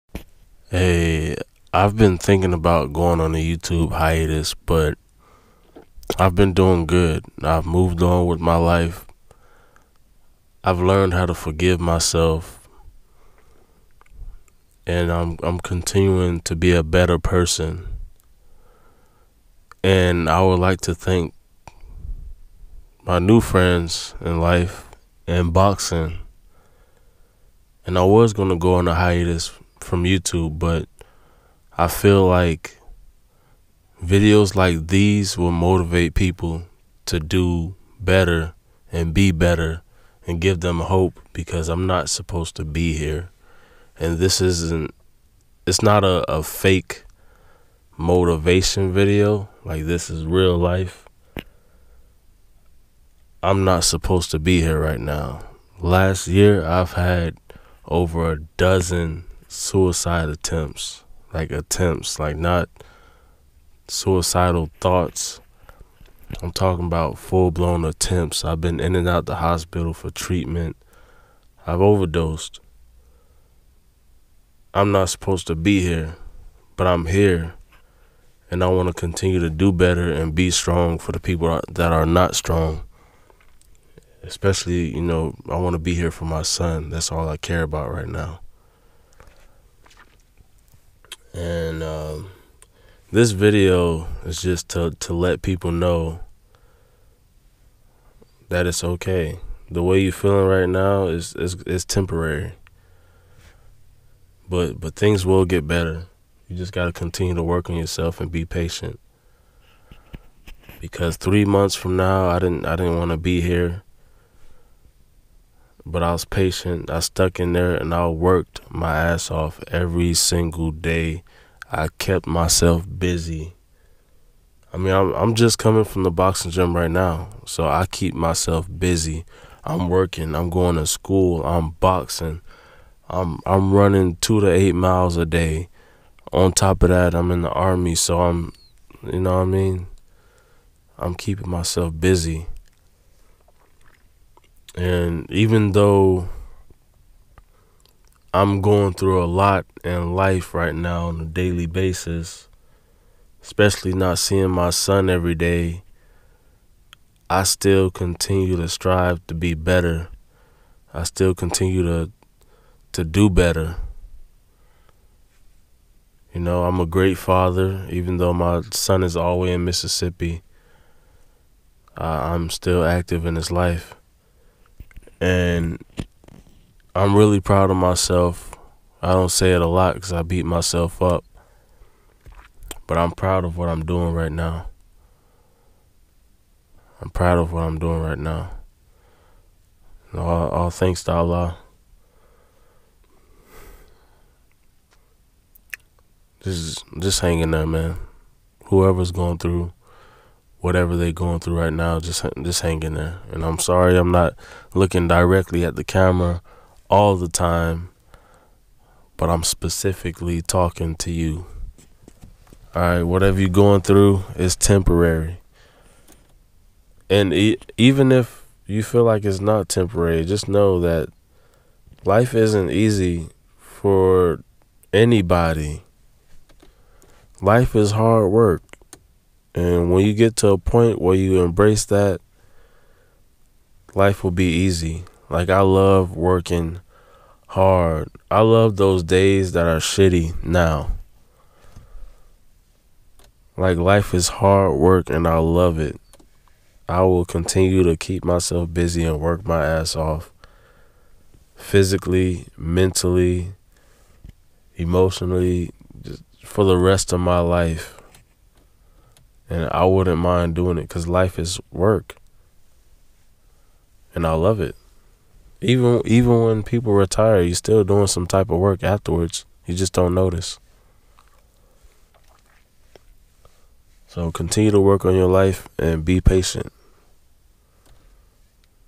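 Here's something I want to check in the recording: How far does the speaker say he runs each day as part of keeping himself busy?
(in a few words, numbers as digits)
2 to 8 miles.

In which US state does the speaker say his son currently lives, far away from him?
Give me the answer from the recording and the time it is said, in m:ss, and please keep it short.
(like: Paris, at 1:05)
Mississippi, at 2:49.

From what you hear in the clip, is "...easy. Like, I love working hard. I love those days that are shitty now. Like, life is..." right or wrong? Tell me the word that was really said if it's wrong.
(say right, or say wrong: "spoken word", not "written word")
right.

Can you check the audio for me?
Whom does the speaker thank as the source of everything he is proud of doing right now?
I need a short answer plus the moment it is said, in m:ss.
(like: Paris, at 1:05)
Allah, at 3:11.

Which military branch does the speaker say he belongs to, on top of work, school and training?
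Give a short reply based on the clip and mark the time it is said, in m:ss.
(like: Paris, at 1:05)
Army, at 2:17.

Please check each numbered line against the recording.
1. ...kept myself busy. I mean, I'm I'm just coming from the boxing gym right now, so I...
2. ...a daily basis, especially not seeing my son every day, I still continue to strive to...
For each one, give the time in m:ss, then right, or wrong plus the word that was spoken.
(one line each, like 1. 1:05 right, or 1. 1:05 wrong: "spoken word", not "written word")
1. 2:01 right
2. 2:31 right.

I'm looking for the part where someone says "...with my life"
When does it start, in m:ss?
0:08.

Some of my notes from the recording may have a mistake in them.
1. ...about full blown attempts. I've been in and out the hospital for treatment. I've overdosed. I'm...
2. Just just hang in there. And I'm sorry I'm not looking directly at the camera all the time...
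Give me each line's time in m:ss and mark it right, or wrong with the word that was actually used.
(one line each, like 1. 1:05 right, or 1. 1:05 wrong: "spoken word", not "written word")
1. 1:06 right
2. 3:21 right.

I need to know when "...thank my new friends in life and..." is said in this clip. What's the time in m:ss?
0:20.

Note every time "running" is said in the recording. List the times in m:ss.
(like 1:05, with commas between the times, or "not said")
2:13.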